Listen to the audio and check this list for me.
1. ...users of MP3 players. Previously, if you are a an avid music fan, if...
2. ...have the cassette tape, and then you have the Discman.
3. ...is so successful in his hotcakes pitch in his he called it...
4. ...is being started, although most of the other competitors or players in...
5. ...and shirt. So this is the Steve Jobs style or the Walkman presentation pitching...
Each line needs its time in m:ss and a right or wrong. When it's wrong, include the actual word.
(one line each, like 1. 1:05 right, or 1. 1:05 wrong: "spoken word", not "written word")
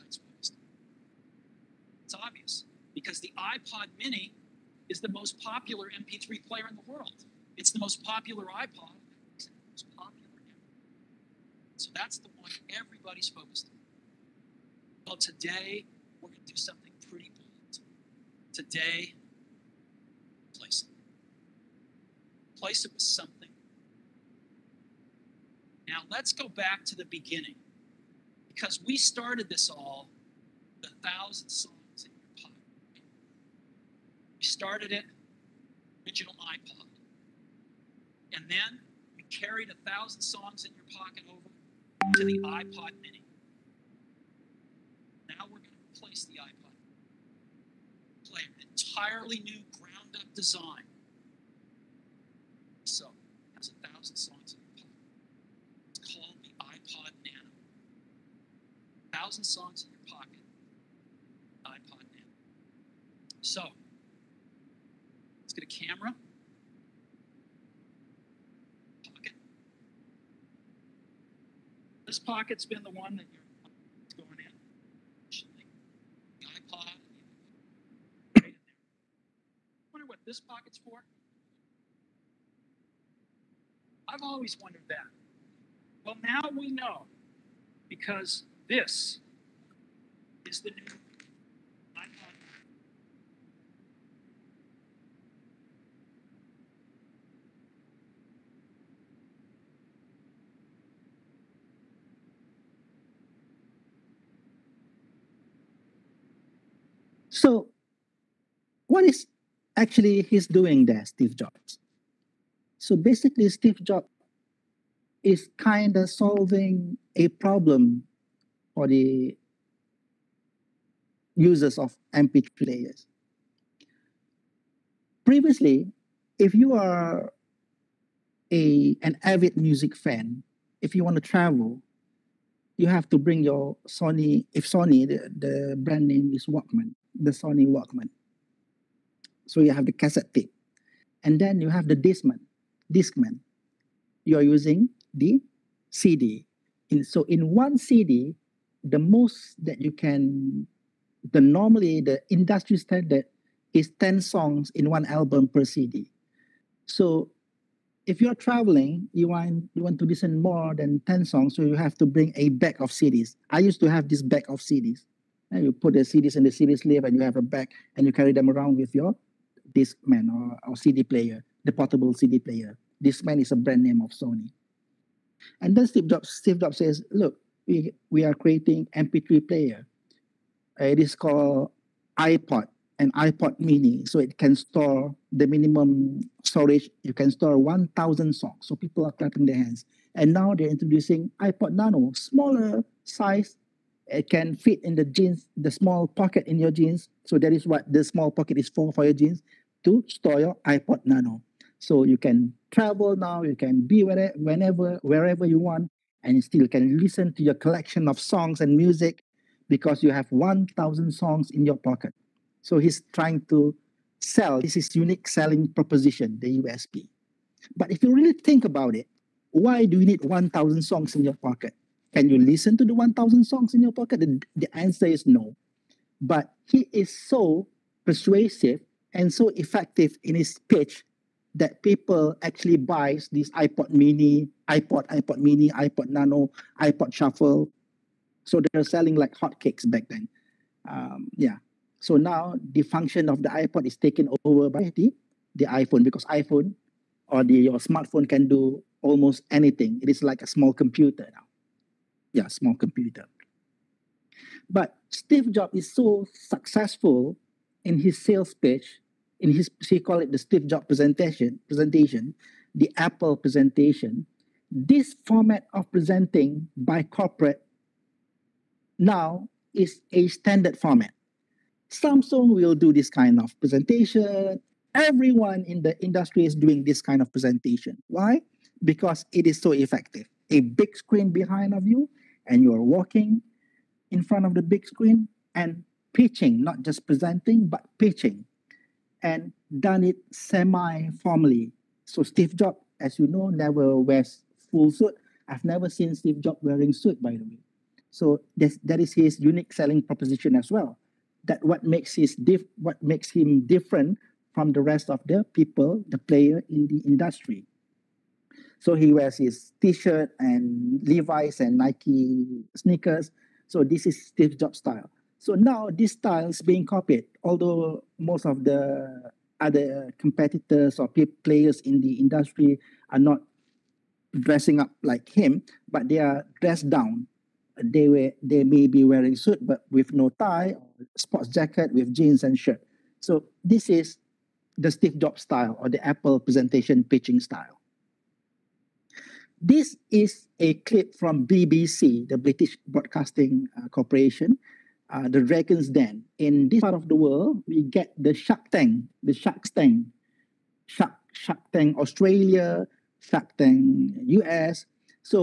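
1. 2:01 right
2. 2:19 right
3. 4:15 wrong: "sales", not "hotcakes"
4. 5:16 wrong: "copied", not "started"
5. 5:32 wrong: "Apple", not "Walkman".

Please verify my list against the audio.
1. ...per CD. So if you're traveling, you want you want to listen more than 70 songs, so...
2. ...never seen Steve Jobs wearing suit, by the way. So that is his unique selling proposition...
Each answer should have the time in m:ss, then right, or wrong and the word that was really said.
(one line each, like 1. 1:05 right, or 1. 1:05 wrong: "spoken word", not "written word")
1. 2:35 wrong: "10", not "70"
2. 4:55 right.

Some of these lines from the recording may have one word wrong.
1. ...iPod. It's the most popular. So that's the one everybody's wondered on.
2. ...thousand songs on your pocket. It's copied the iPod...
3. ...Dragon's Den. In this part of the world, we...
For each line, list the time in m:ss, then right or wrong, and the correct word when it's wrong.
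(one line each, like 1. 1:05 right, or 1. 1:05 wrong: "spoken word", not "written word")
1. 0:08 wrong: "focused", not "wondered"
2. 0:54 wrong: "called", not "copied"
3. 5:45 right.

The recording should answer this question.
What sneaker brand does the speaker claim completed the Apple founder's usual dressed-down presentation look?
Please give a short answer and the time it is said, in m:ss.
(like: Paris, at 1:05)
Nike, at 5:11.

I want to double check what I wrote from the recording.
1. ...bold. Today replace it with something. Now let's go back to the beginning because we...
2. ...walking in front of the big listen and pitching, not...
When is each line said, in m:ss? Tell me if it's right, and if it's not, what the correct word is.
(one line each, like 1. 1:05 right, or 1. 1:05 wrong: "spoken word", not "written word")
1. 0:17 right
2. 4:42 wrong: "screen", not "listen".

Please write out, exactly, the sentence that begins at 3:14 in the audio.
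It can fit in the jeans, the small pocket in your jeans.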